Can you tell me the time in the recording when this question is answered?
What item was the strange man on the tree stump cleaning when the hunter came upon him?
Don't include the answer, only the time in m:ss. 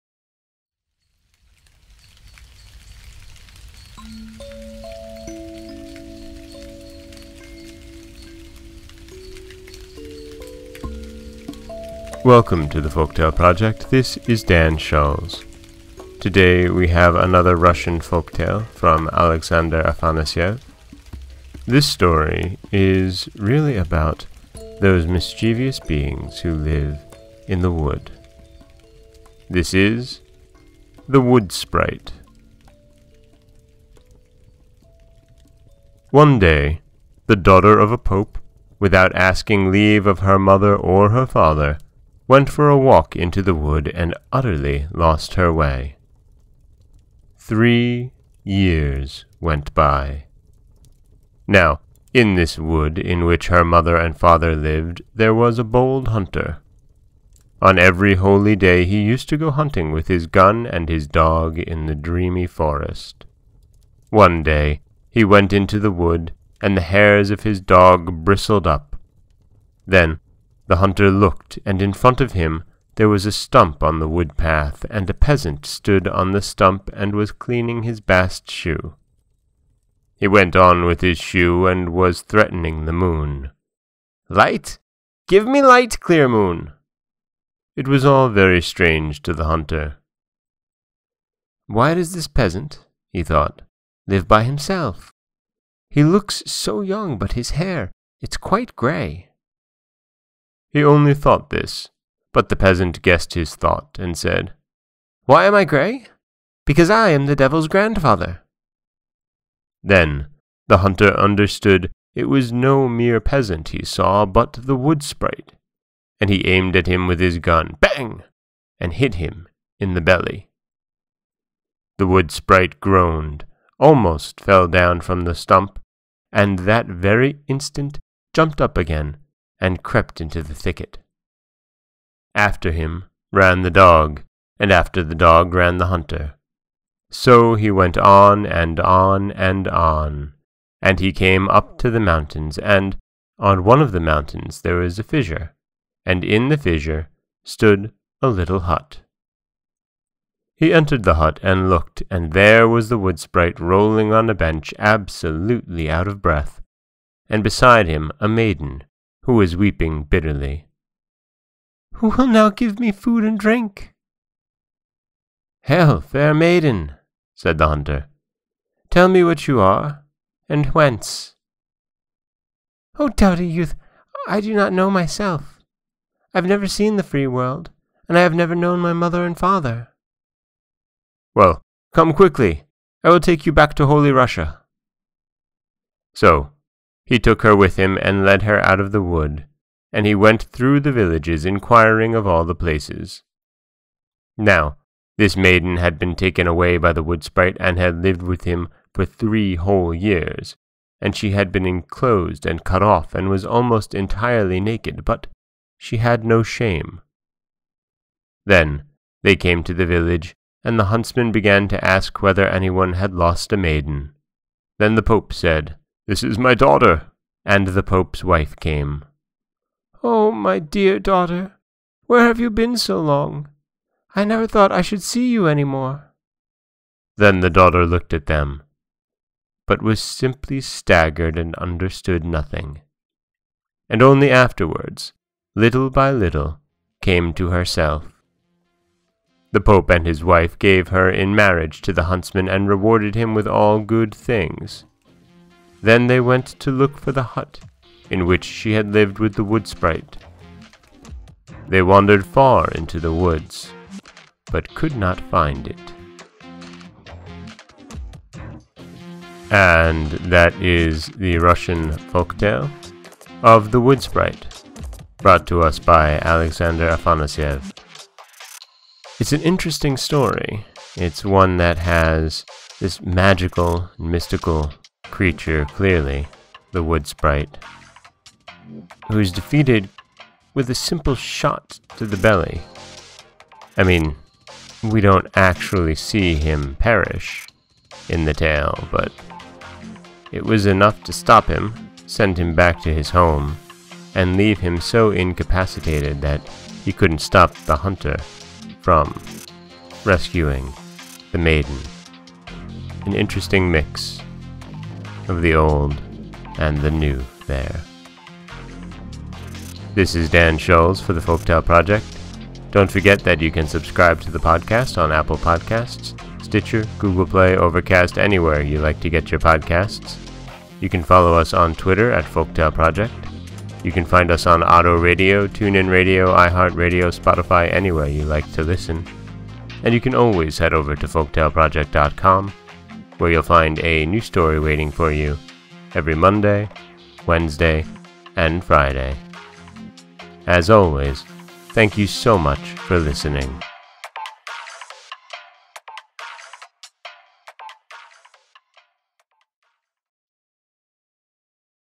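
1:17.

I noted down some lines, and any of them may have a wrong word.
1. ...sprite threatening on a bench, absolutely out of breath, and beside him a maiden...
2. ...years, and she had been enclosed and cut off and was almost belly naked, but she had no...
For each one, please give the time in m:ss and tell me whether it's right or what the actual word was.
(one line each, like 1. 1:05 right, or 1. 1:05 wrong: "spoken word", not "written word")
1. 2:33 wrong: "rolling", not "threatening"
2. 3:19 wrong: "entirely", not "belly".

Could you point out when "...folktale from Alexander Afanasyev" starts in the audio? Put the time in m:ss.
0:17.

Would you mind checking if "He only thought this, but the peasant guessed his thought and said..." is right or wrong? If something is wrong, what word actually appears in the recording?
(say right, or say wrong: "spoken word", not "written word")
right.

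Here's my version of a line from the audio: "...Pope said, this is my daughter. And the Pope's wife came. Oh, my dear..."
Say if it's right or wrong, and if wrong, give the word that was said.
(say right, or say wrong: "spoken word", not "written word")
right.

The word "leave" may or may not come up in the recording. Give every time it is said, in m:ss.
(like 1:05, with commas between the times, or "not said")
0:39, 4:54.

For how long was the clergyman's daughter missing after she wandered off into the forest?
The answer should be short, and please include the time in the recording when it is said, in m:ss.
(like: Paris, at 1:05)
Three years, at 0:47.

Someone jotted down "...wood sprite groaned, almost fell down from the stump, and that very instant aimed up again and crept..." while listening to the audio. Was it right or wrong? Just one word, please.
wrong.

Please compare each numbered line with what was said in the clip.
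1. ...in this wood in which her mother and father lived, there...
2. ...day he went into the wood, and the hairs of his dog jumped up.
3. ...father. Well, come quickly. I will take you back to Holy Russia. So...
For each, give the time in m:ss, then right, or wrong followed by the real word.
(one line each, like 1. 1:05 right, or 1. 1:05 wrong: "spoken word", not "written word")
1. 0:52 right
2. 1:04 wrong: "bristled", not "jumped"
3. 2:59 right.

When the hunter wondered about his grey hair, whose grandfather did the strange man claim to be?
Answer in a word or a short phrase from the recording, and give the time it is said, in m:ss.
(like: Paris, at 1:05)
The devil's, at 1:47.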